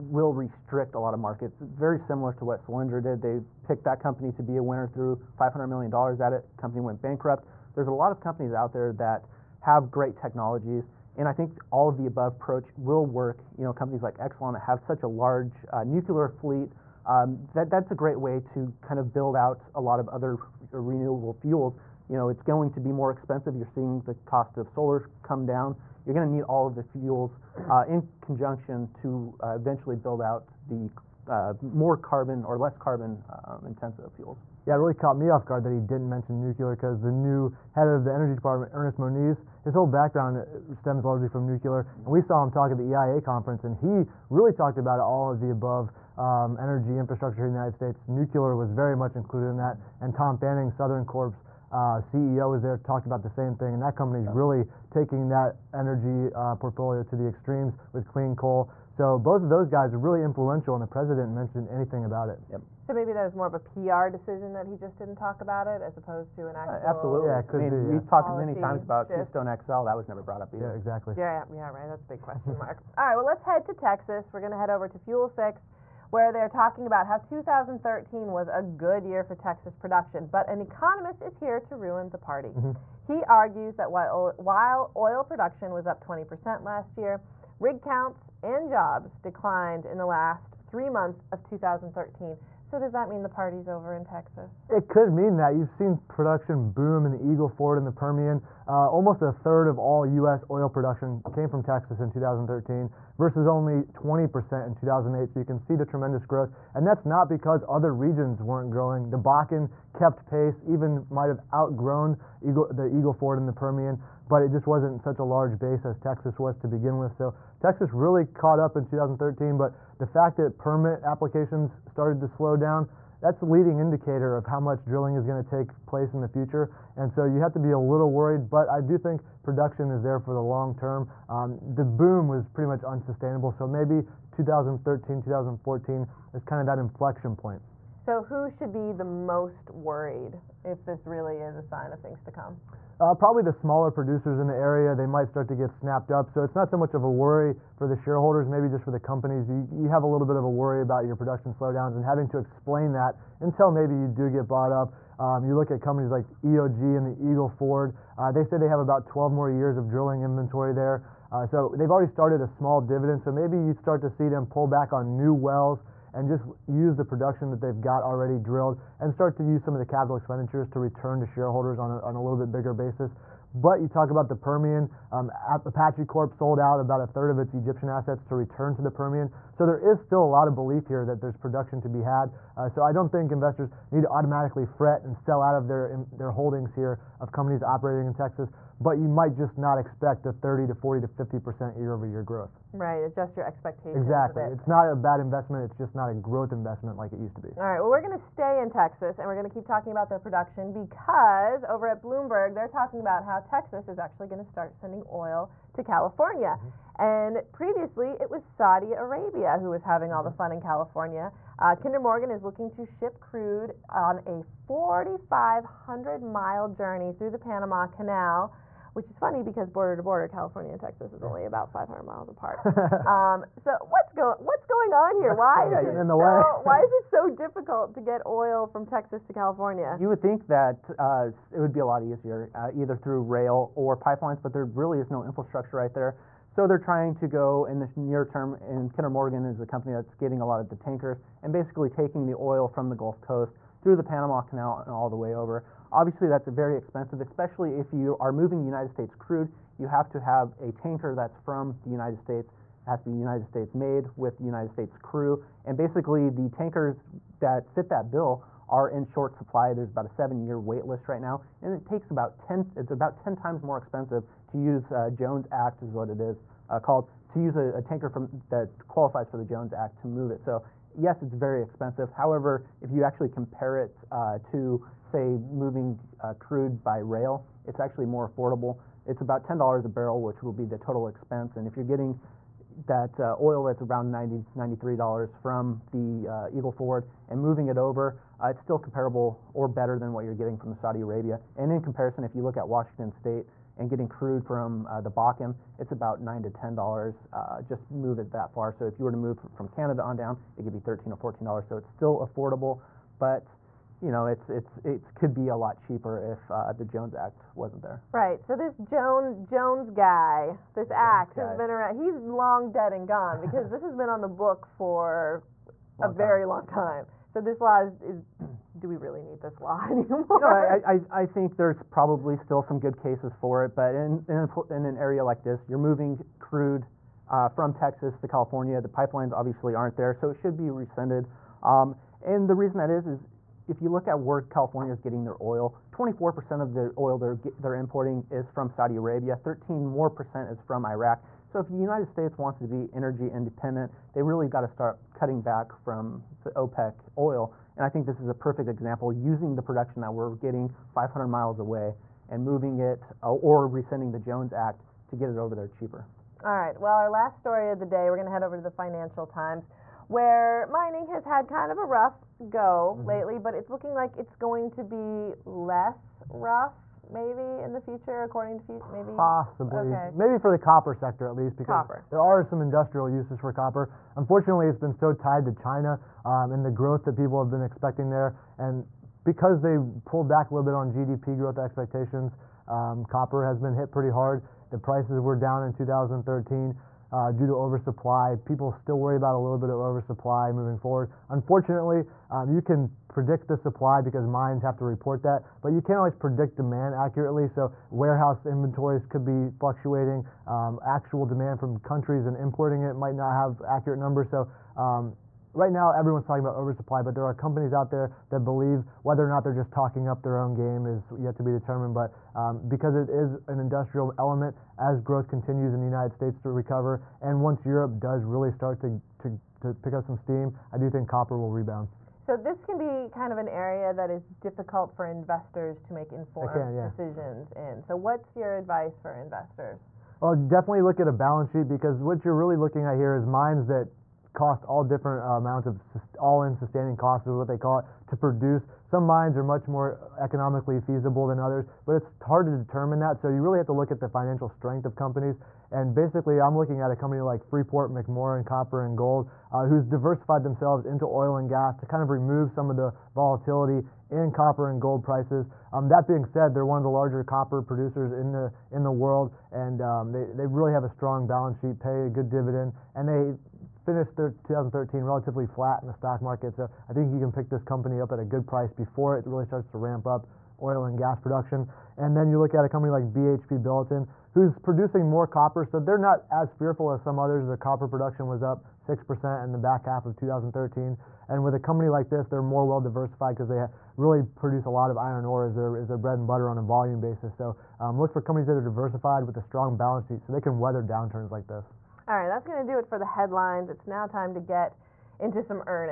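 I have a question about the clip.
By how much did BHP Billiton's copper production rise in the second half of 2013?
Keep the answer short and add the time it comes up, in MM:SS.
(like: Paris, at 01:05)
6%, at 07:58.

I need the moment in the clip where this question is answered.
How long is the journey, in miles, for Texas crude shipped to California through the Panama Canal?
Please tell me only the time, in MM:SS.
03:34.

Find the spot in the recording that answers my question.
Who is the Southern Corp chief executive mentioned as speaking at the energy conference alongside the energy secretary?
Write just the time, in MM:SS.
00:50.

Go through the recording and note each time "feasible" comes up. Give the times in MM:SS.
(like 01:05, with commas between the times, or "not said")
07:20.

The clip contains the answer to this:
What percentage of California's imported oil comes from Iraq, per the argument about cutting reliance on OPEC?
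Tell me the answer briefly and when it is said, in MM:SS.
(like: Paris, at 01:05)
13%, at 05:39.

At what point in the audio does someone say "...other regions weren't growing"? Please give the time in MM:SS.
01:47.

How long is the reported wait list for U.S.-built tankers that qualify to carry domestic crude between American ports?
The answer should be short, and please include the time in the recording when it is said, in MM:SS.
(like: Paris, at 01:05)
7 years, at 04:20.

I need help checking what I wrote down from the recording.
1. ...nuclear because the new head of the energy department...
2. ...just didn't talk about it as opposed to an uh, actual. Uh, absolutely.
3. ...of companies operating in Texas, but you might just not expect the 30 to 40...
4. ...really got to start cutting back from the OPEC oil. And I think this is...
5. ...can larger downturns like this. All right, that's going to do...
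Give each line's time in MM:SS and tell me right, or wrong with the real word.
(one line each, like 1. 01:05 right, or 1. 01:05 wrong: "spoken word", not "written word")
1. 00:36 right
2. 01:04 right
3. 03:07 right
4. 05:44 right
5. 08:10 wrong: "weather", not "larger".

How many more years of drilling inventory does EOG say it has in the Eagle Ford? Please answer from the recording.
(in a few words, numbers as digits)
12.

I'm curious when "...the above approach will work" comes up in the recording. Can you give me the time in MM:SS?
00:11.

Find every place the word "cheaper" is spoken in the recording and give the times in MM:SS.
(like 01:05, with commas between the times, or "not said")
05:05, 05:55.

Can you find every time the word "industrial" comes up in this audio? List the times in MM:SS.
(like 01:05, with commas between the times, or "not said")
06:12, 06:53.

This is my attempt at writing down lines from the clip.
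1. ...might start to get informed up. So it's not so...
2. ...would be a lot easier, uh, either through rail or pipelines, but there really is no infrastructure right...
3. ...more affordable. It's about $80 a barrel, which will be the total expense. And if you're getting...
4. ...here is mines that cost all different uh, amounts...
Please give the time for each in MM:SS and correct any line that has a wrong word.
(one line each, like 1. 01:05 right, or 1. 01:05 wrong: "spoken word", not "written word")
1. 02:25 wrong: "snapped", not "informed"
2. 03:51 right
3. 04:38 wrong: "10", not "80"
4. 07:12 right.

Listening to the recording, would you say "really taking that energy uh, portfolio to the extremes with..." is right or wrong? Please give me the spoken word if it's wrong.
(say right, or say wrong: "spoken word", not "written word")
right.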